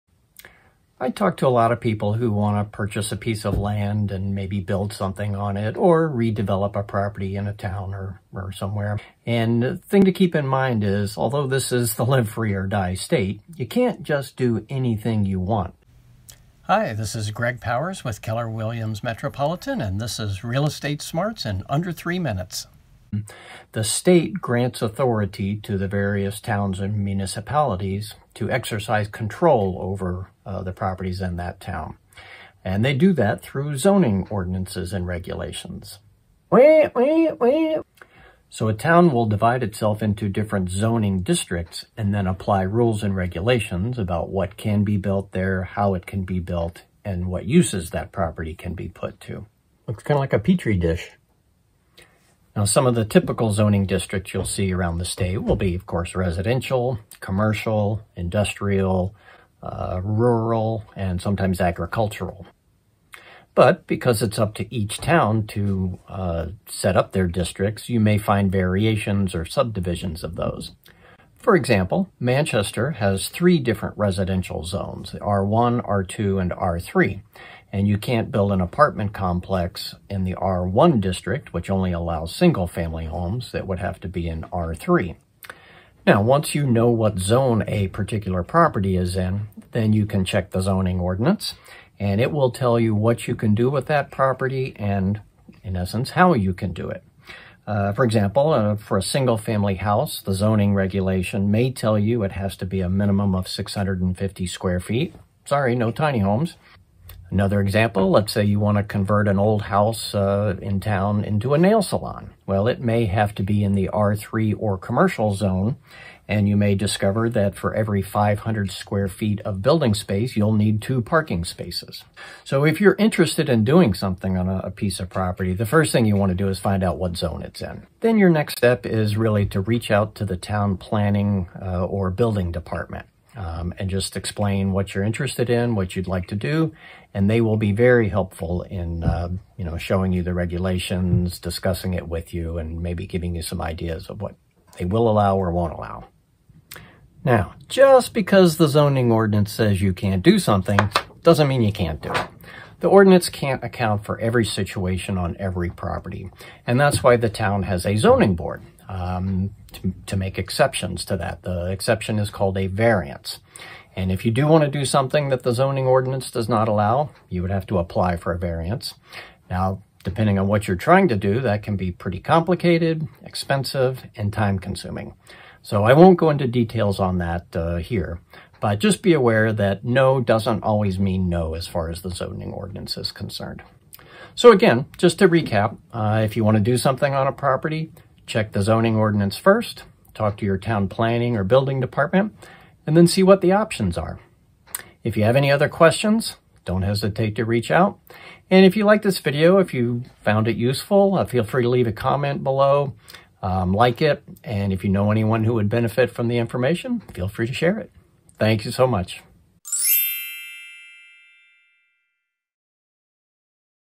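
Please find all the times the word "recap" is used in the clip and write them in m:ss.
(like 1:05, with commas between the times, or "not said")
3:05.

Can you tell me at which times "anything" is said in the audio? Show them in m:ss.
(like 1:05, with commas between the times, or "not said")
0:14.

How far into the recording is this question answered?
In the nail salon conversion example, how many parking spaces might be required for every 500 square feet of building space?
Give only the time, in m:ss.
2:00.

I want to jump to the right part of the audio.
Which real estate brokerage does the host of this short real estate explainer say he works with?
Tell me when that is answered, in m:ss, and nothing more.
0:18.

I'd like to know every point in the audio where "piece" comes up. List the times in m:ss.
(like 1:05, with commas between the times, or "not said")
0:03, 2:04.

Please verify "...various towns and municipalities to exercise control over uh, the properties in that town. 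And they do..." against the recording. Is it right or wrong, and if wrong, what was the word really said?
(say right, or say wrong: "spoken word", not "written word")
right.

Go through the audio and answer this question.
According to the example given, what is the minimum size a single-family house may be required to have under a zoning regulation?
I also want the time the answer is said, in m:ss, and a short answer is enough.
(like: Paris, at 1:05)
650 square feet, at 1:43.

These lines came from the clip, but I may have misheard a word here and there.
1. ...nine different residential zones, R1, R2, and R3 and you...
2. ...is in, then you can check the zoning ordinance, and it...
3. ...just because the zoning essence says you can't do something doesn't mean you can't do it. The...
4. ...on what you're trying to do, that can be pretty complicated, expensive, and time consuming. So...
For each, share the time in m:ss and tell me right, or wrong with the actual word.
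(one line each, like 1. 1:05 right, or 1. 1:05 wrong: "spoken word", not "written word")
1. 1:13 wrong: "three", not "nine"
2. 1:28 right
3. 2:27 wrong: "ordinance", not "essence"
4. 2:50 right.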